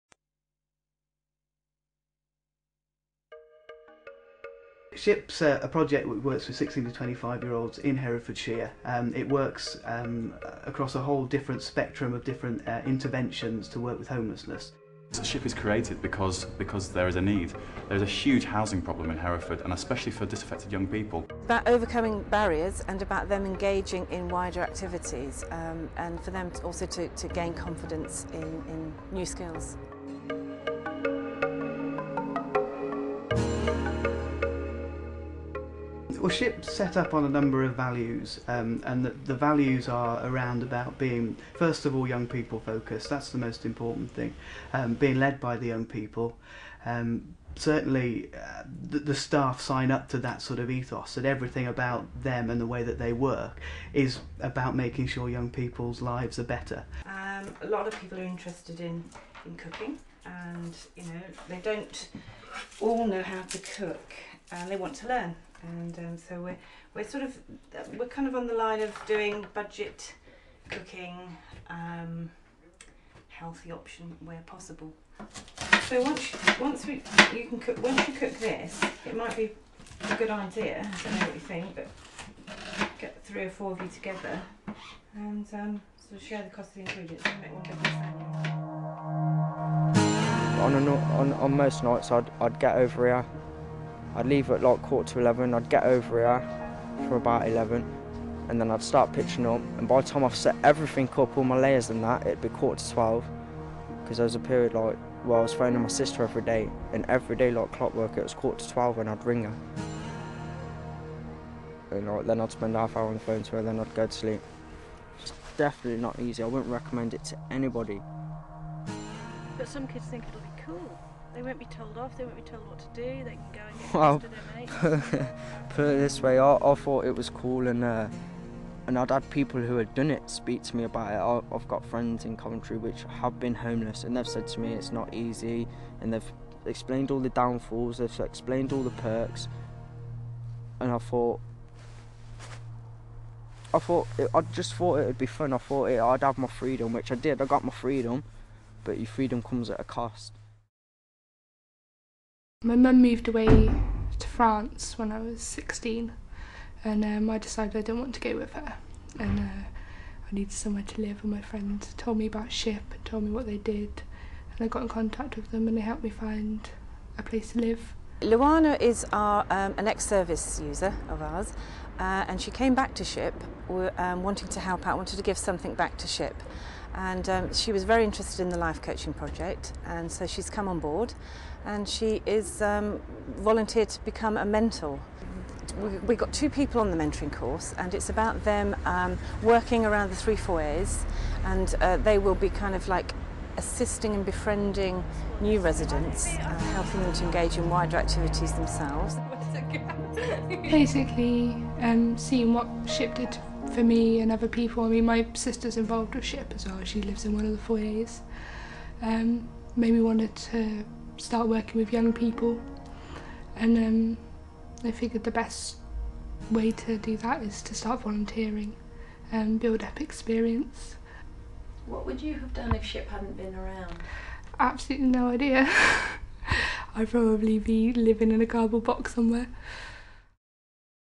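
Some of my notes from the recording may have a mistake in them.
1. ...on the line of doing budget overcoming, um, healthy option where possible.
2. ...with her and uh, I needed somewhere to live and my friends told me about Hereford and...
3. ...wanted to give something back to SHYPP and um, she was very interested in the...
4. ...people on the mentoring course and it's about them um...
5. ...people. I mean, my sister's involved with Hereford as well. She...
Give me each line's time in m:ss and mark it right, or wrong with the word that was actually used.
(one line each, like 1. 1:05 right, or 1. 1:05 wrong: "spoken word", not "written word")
1. 1:08 wrong: "cooking", not "overcoming"
2. 2:38 wrong: "SHYPP", not "Hereford"
3. 2:54 right
4. 3:06 right
5. 3:24 wrong: "SHYPP", not "Hereford".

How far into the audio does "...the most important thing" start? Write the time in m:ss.
0:43.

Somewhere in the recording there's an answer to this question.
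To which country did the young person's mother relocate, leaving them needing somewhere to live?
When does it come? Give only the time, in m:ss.
2:34.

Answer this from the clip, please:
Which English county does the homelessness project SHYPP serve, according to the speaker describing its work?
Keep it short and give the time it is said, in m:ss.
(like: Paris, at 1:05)
Herefordshire, at 0:07.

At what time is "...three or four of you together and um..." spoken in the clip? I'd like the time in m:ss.
1:23.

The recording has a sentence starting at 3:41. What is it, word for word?
What would you have done if SHYPP hadn't been around?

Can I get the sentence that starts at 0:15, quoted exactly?
So SHYPP is created because, because there is a need.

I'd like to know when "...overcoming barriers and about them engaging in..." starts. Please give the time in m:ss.
0:21.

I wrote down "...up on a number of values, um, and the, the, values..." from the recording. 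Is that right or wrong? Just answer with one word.
right.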